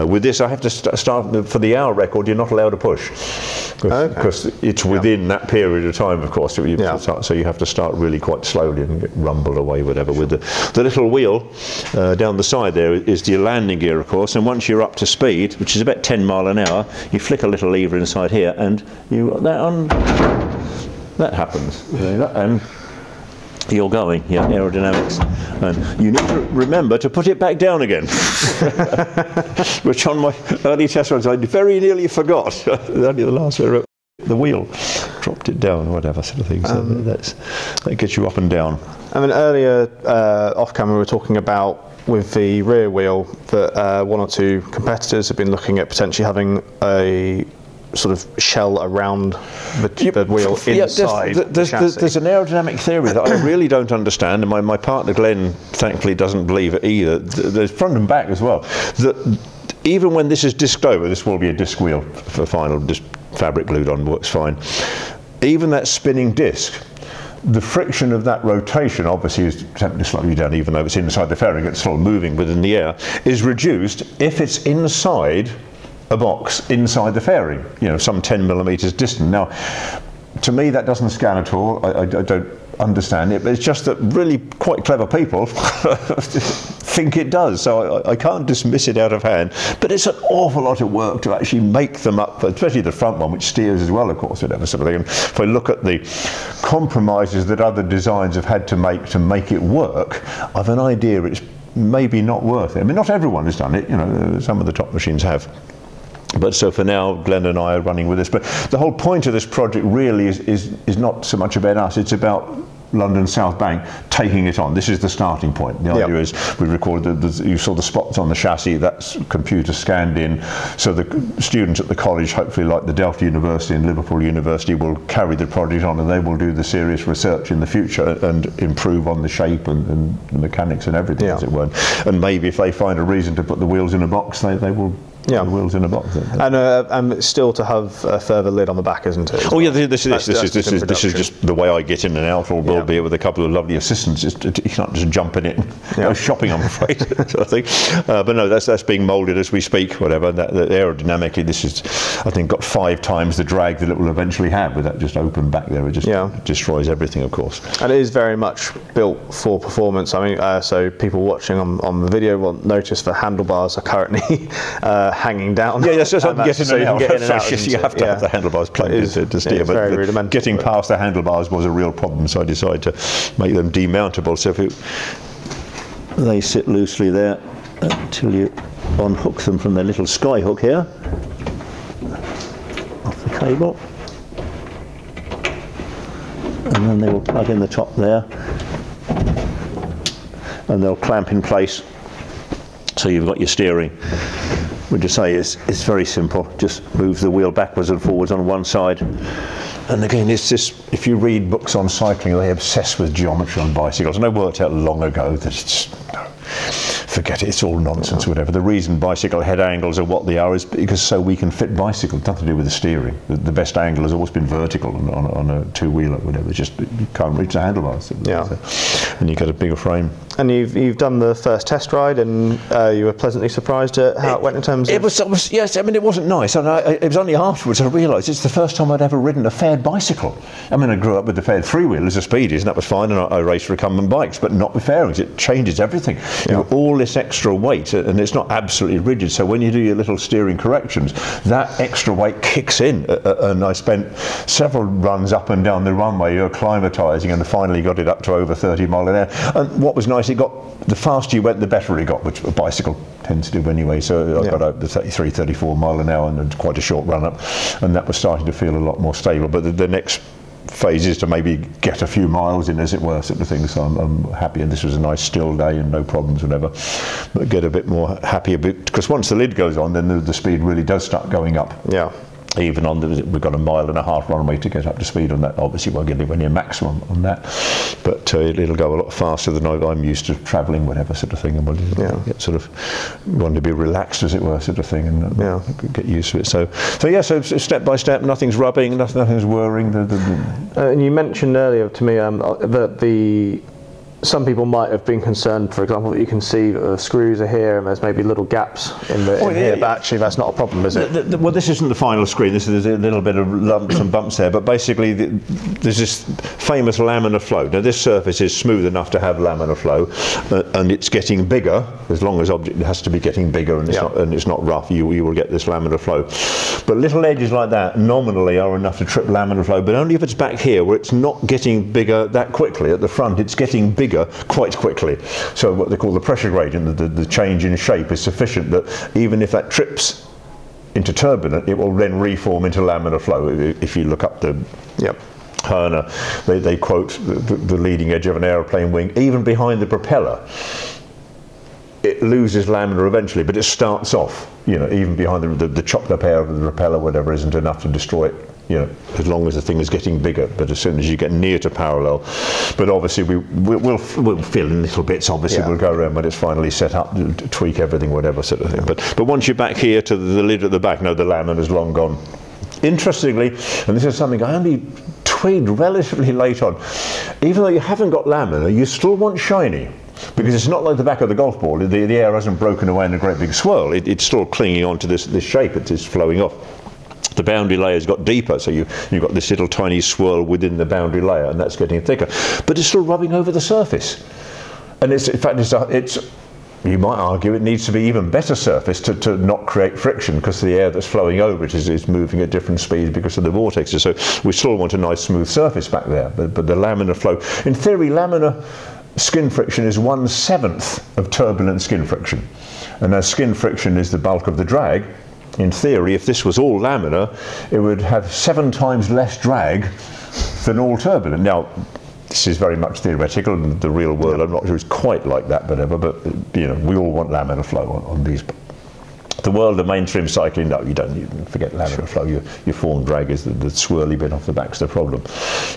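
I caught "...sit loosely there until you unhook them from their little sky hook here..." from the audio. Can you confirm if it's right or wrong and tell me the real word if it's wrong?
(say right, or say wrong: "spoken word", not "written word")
right.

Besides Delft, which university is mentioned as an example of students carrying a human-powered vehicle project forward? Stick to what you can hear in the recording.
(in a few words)
Liverpool University.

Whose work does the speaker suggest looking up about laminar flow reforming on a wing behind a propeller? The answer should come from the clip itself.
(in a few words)
Hoerner.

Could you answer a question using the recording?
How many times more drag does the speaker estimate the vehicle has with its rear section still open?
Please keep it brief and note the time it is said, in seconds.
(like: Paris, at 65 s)
5, at 152 s.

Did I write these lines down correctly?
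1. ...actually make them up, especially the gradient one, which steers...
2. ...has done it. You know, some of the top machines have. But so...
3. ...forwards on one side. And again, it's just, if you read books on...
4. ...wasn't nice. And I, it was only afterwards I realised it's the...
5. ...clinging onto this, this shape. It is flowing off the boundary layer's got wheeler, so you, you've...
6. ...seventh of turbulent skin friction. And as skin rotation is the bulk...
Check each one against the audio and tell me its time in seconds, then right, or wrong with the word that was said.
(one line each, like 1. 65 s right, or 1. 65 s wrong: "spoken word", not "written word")
1. 91 s wrong: "front", not "gradient"
2. 103 s right
3. 198 s right
4. 226 s right
5. 374 s wrong: "deeper", not "wheeler"
6. 400 s wrong: "friction", not "rotation".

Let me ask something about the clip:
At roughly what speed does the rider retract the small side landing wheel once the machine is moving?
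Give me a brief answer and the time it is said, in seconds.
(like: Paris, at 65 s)
10 mph, at 15 s.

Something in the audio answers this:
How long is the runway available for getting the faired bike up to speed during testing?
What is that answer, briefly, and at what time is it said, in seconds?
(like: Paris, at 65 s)
a mile and a half, at 273 s.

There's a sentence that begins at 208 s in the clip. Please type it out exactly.
The reason bicycle head angles are what they are is because so we can fit bicycles, nothing to do with the steering.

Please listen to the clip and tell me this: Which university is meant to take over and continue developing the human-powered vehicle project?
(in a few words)
London South Bank.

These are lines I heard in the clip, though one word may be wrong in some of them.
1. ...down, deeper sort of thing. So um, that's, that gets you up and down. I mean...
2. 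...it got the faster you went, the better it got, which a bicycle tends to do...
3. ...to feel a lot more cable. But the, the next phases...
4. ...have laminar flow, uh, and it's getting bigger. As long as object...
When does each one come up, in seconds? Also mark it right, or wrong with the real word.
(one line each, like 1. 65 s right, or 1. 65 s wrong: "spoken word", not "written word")
1. 35 s wrong: "whatever", not "deeper"
2. 250 s right
3. 258 s wrong: "stable", not "cable"
4. 309 s right.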